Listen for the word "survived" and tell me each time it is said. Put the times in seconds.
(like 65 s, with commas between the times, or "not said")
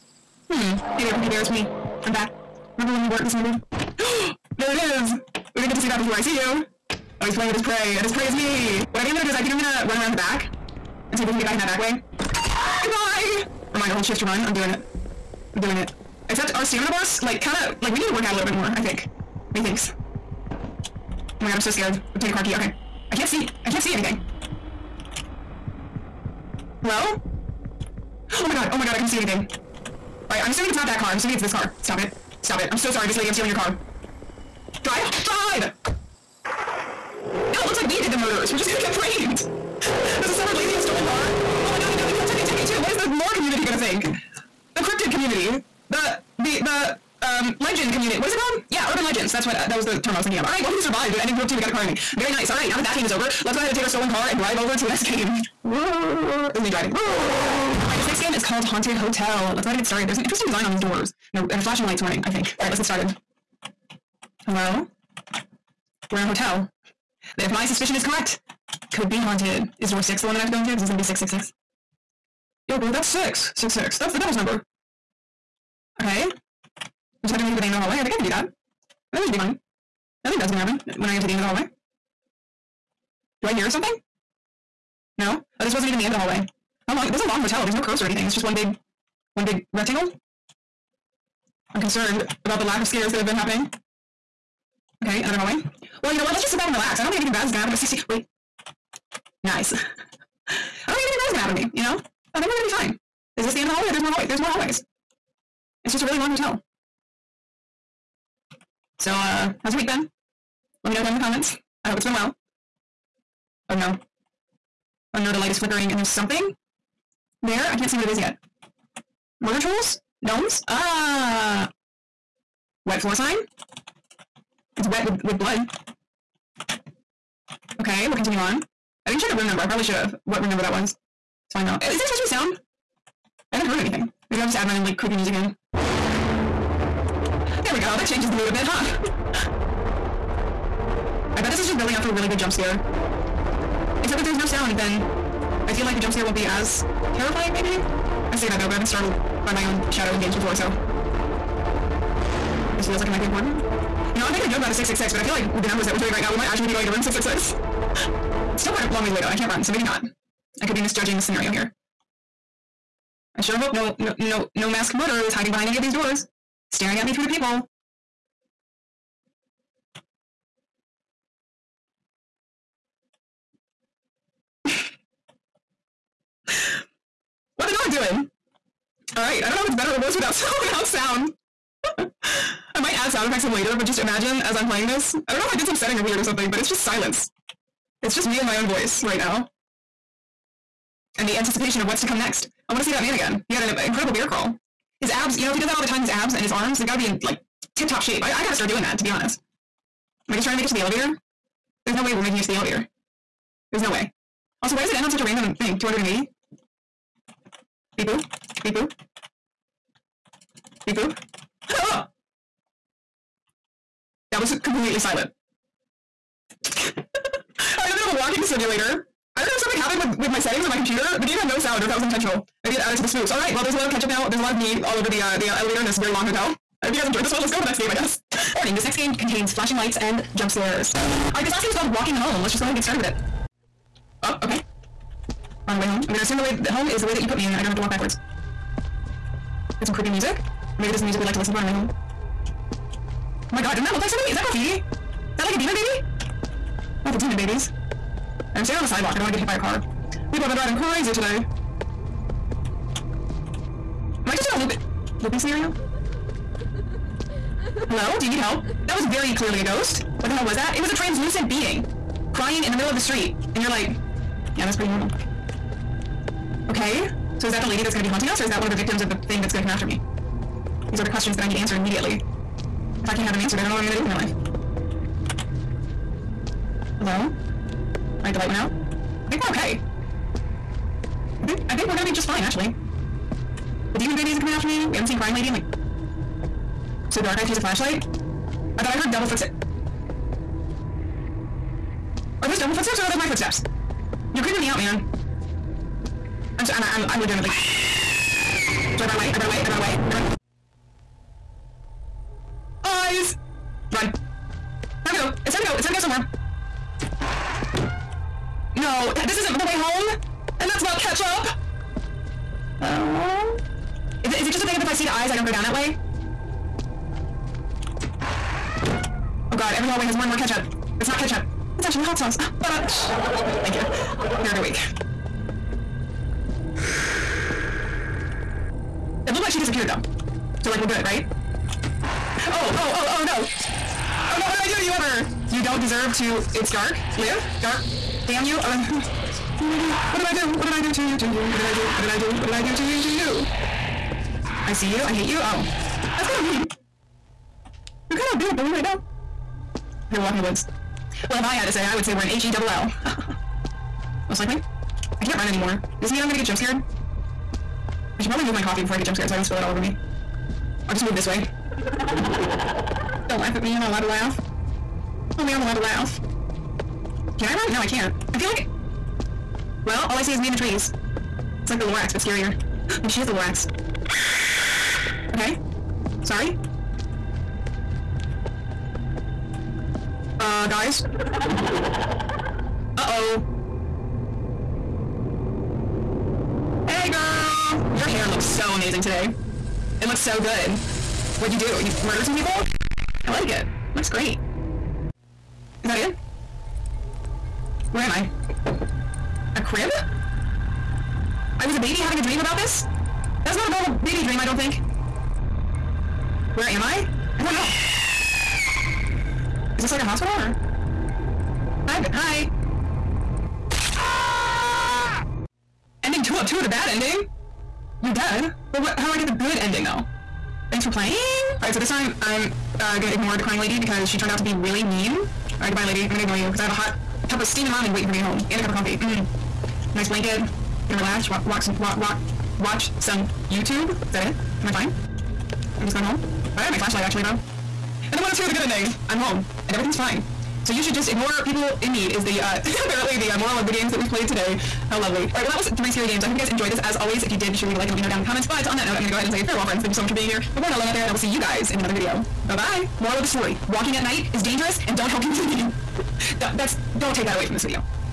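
50 s.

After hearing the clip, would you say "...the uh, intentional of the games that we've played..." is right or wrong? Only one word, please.
wrong.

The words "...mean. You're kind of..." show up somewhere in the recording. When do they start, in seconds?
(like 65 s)
346 s.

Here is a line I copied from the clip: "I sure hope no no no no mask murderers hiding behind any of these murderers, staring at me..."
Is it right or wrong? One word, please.
wrong.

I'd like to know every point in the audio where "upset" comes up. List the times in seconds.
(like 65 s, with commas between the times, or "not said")
not said.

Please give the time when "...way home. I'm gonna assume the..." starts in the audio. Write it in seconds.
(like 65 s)
235 s.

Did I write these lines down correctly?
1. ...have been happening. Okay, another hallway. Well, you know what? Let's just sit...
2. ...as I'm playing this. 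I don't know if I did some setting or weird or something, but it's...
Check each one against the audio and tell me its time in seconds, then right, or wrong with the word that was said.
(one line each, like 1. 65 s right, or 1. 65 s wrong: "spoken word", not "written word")
1. 93 s right
2. 184 s right.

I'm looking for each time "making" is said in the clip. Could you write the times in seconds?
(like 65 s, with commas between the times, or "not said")
154 s, 202 s.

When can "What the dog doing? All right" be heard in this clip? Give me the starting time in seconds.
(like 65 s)
177 s.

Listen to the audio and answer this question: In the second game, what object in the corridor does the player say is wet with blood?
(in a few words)
wet floor sign.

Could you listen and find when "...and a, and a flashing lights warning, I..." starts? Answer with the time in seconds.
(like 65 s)
61 s.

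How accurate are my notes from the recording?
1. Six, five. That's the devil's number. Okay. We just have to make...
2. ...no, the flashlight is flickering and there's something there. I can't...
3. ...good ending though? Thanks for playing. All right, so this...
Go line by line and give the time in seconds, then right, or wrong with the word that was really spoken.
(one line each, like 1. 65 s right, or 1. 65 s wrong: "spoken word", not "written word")
1. 73 s wrong: "six", not "five"
2. 115 s wrong: "light", not "flashlight"
3. 419 s right.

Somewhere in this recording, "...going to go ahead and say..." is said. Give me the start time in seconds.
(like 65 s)
449 s.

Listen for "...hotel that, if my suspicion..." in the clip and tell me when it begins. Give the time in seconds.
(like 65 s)
66 s.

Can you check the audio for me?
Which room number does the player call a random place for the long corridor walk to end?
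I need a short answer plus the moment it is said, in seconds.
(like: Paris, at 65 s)
280, at 205 s.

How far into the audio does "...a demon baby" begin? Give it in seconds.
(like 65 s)
245 s.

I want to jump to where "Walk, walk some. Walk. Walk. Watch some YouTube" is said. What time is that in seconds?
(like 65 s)
431 s.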